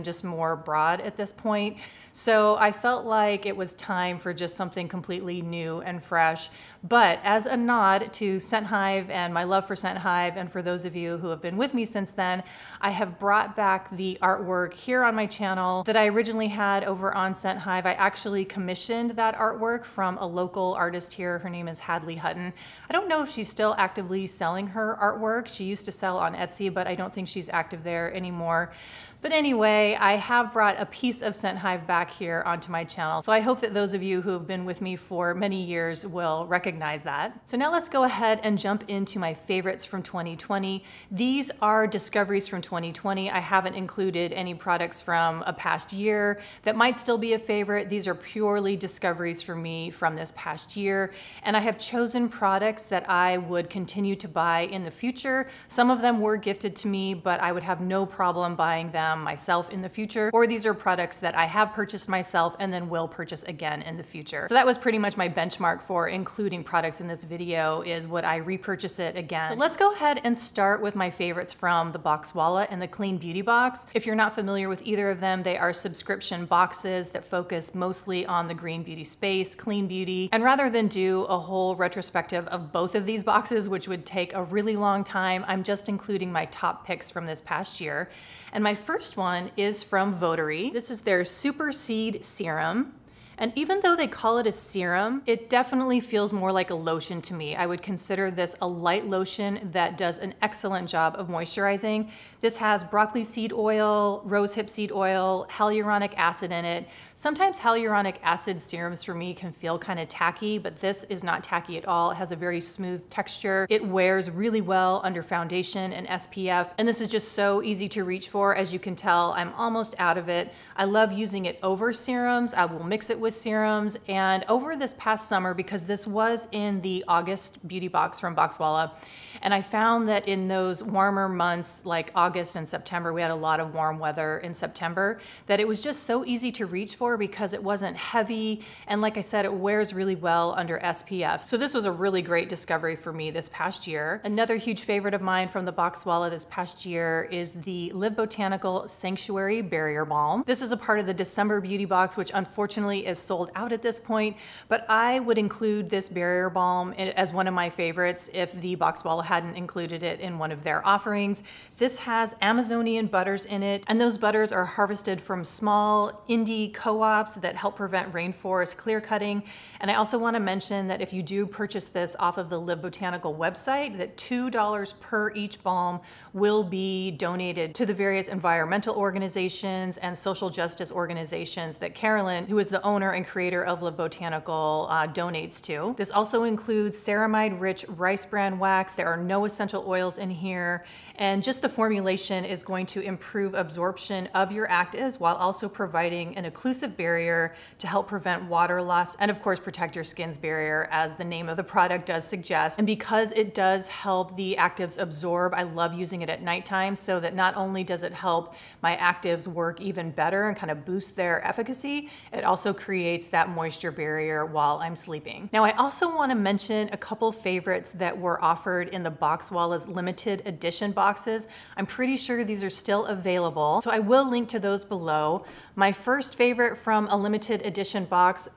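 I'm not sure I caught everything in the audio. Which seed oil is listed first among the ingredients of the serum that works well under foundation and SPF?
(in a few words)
broccoli seed oil.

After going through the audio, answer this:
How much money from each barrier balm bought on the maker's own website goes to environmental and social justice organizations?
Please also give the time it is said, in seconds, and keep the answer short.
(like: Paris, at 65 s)
$2, at 174 s.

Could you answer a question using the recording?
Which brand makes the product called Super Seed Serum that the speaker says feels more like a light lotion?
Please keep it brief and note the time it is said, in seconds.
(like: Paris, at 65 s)
Votary, at 90 s.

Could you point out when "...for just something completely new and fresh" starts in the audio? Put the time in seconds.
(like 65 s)
4 s.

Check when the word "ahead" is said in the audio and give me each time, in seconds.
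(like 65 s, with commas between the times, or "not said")
38 s, 69 s.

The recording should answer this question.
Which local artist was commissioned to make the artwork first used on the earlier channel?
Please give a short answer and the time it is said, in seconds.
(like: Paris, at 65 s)
Hadley Hutton, at 21 s.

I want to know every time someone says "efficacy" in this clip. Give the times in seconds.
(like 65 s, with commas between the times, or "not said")
211 s.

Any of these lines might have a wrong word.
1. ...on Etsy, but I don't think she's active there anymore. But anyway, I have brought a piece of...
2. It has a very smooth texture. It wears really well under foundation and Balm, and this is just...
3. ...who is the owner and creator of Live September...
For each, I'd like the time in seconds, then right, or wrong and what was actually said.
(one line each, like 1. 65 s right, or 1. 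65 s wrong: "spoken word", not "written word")
1. 26 s right
2. 112 s wrong: "SPF", not "Balm"
3. 182 s wrong: "Botanical", not "September".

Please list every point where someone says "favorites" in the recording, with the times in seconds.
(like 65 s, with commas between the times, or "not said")
39 s, 47 s, 71 s, 144 s, 157 s, 217 s, 226 s.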